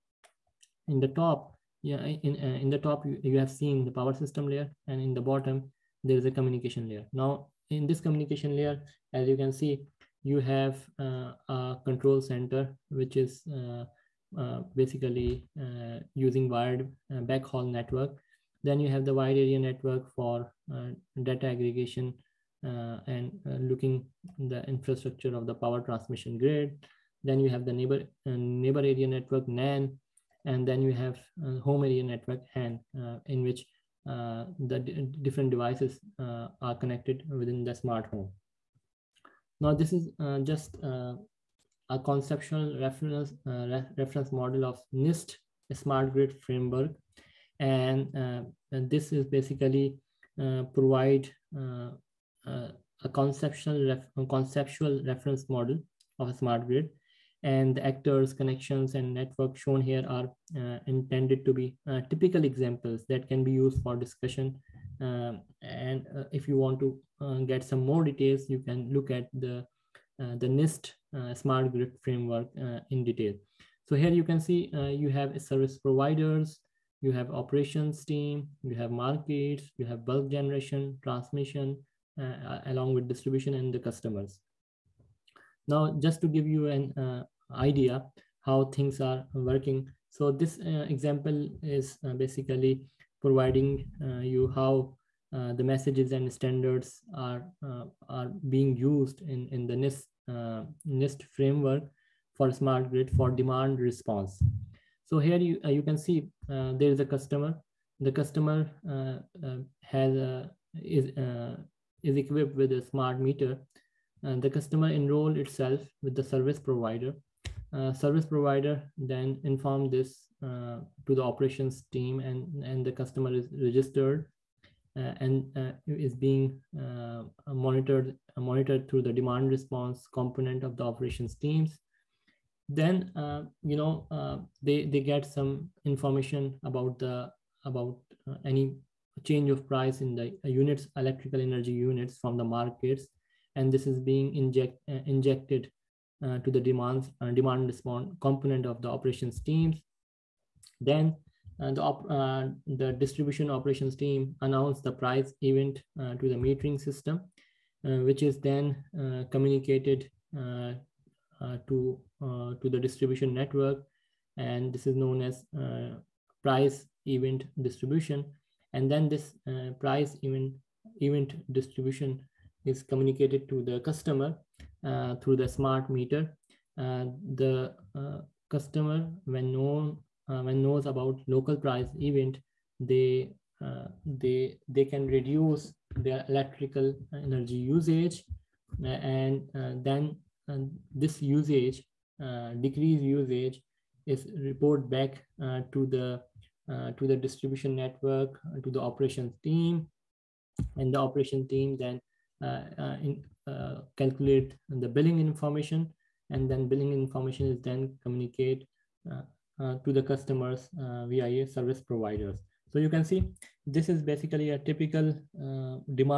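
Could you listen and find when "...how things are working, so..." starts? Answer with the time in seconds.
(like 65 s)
88 s.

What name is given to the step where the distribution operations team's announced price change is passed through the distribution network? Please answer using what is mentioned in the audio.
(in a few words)
Price event distribution.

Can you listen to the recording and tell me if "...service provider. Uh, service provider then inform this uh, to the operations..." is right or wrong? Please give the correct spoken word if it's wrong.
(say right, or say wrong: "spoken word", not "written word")
right.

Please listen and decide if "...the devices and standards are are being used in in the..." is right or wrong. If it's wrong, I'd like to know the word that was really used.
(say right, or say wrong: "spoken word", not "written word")
wrong: "messages", not "devices".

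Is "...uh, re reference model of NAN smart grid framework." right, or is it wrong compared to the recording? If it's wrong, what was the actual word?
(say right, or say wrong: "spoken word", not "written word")
wrong: "NIST", not "NAN".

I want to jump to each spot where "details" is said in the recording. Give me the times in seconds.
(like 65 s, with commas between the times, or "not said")
68 s, 73 s.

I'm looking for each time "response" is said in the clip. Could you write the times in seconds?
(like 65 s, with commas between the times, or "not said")
103 s, 129 s, 147 s.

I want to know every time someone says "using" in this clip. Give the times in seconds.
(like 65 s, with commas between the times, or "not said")
16 s.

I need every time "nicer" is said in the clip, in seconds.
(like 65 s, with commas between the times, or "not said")
not said.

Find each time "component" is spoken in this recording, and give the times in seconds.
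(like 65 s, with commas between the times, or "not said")
130 s, 148 s.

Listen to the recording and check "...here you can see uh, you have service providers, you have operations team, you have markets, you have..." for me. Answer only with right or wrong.
right.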